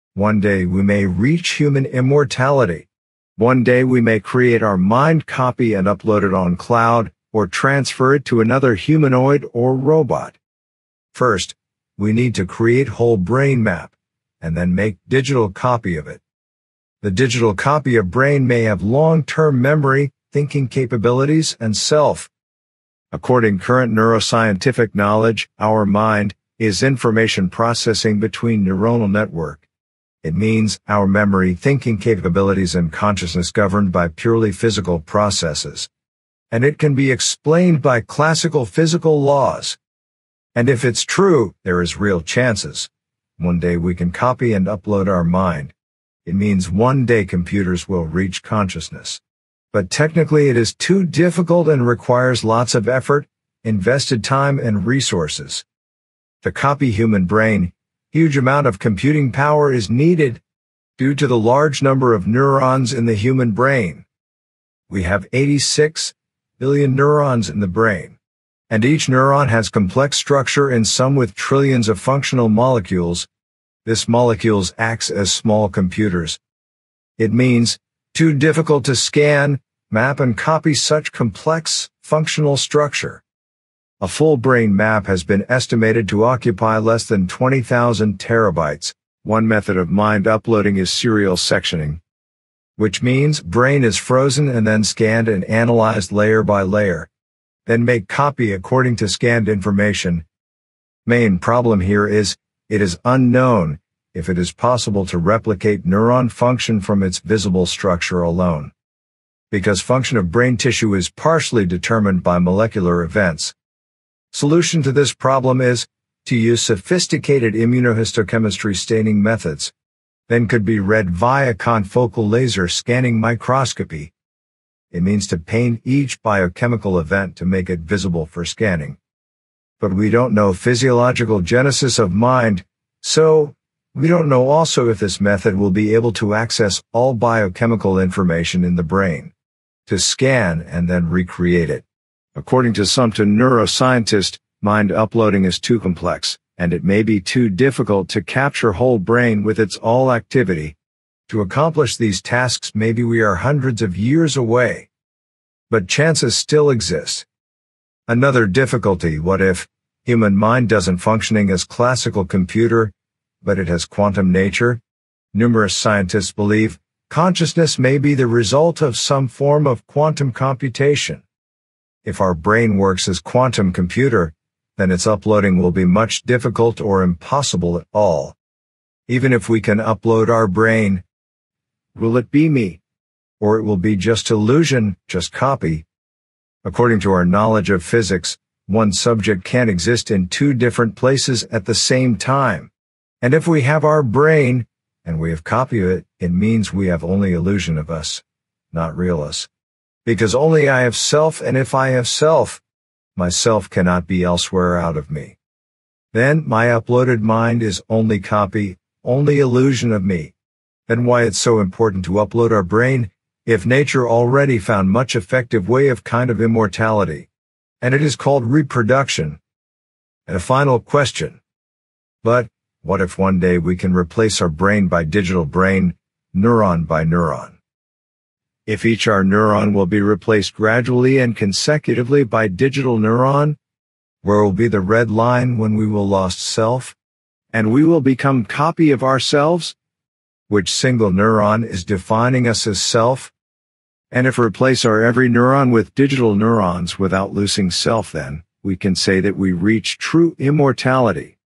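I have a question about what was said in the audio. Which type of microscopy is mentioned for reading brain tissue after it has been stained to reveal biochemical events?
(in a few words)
confocal laser scanning microscopy.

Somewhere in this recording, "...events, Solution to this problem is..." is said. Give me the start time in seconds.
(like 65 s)
113 s.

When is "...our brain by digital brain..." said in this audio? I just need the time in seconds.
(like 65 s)
224 s.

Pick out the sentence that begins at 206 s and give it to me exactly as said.
Then my uploaded mind is only copy, only illusion of me.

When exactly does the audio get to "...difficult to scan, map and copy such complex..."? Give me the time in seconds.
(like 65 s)
78 s.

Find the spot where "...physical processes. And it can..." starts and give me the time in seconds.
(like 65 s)
34 s.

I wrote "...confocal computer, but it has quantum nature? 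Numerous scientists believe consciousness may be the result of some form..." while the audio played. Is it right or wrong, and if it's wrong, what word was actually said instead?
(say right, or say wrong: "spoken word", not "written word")
wrong: "classical", not "confocal".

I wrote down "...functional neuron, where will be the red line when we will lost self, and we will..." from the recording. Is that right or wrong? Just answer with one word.
wrong.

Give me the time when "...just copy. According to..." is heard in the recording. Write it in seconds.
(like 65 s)
185 s.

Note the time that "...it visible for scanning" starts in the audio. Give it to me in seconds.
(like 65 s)
127 s.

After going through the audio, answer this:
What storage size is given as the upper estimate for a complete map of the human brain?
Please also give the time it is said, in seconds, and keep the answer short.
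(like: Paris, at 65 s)
20,000 terabytes, at 87 s.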